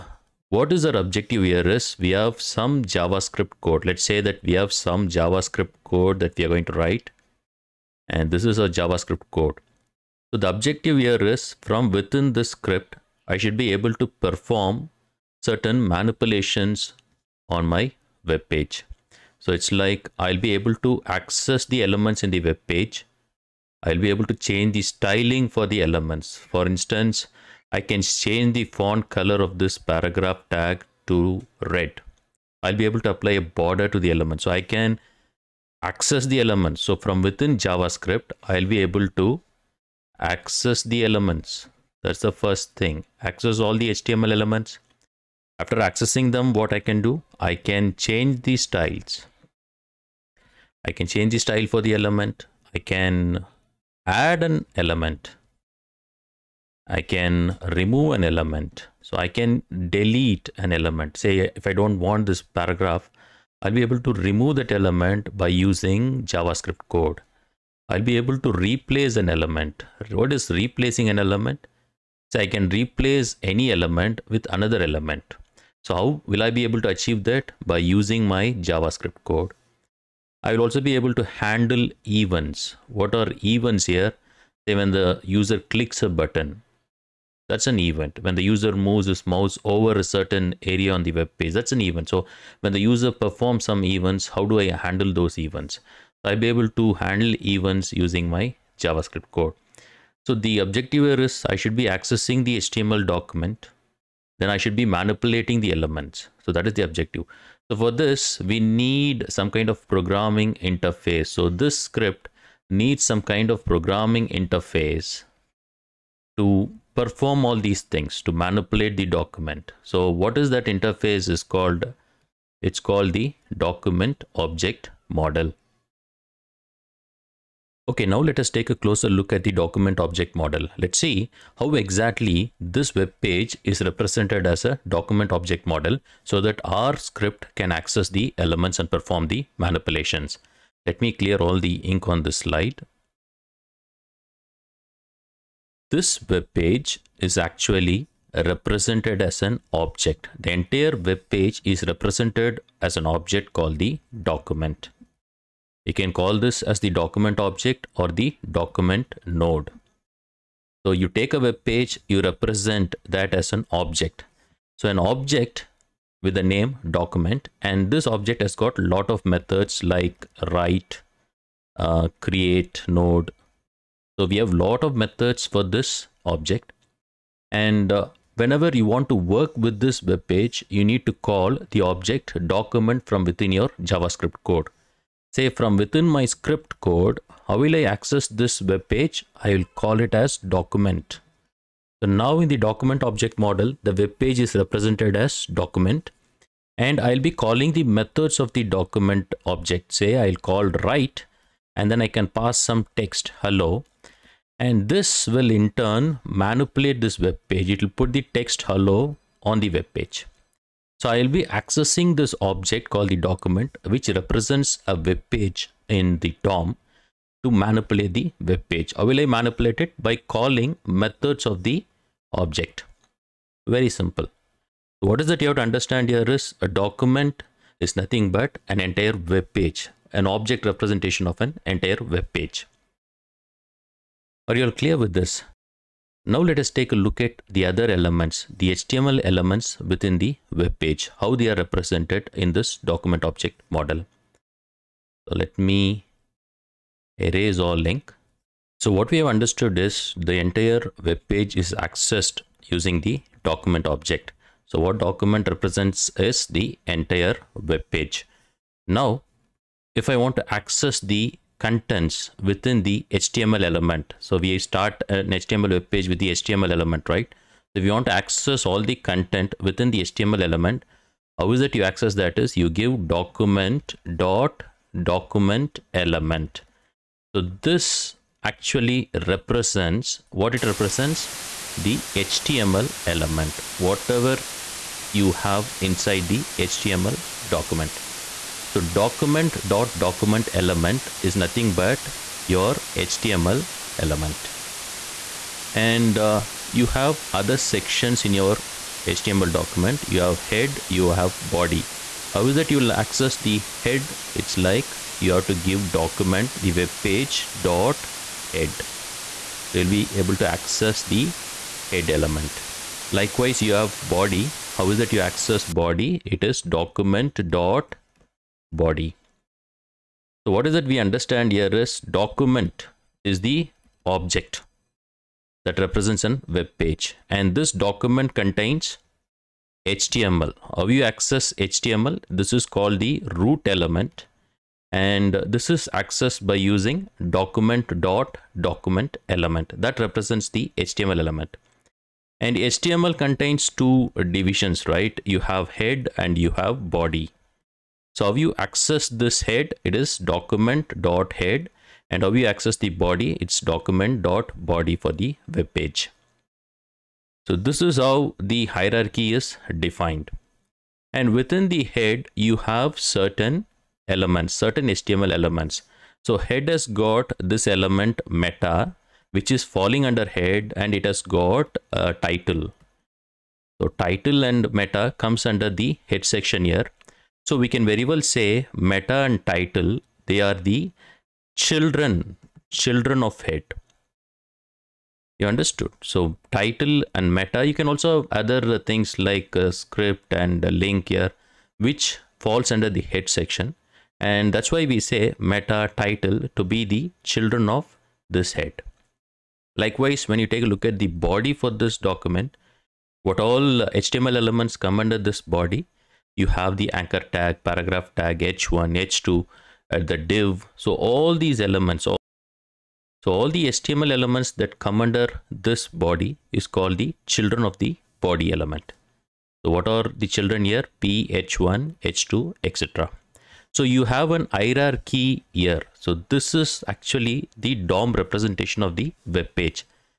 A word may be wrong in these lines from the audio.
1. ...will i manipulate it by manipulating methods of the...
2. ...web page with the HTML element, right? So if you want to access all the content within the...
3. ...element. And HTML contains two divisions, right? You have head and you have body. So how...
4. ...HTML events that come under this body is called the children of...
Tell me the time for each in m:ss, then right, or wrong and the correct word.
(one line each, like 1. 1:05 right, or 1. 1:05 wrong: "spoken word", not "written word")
1. 3:39 wrong: "calling", not "manipulating"
2. 4:25 right
3. 5:41 right
4. 6:53 wrong: "elements", not "events".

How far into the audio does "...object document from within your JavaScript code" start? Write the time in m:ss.
3:01.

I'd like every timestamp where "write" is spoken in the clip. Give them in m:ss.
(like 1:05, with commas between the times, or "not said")
0:06, 2:50, 3:20.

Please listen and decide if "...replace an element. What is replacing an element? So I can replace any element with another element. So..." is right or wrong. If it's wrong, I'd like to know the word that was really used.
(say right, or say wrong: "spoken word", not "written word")
right.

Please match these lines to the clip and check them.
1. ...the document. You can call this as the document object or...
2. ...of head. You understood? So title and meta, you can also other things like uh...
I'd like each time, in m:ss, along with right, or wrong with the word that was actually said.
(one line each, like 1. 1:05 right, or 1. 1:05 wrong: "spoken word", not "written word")
1. 2:33 right
2. 6:23 right.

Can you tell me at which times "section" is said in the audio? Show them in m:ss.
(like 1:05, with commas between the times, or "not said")
4:57, 6:16, 6:33.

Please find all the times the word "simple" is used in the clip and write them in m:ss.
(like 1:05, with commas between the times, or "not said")
3:43.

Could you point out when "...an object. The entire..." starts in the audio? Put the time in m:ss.
2:29.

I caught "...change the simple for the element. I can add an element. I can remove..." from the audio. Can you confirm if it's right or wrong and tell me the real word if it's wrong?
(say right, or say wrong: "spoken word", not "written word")
wrong: "style", not "simple".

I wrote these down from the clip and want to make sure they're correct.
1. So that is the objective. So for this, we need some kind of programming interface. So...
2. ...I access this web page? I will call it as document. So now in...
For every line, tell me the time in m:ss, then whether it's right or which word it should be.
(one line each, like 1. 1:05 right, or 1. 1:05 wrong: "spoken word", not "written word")
1. 1:46 right
2. 3:07 right.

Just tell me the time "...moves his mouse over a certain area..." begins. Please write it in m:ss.
1:28.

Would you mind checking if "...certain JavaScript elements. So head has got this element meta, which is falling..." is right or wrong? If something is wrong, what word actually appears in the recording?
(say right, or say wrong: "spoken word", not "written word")
wrong: "HTML", not "JavaScript".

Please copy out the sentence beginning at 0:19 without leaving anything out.
So it's like I'll be able to access the elements in the web page.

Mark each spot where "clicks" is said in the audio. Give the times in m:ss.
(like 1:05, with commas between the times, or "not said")
1:25.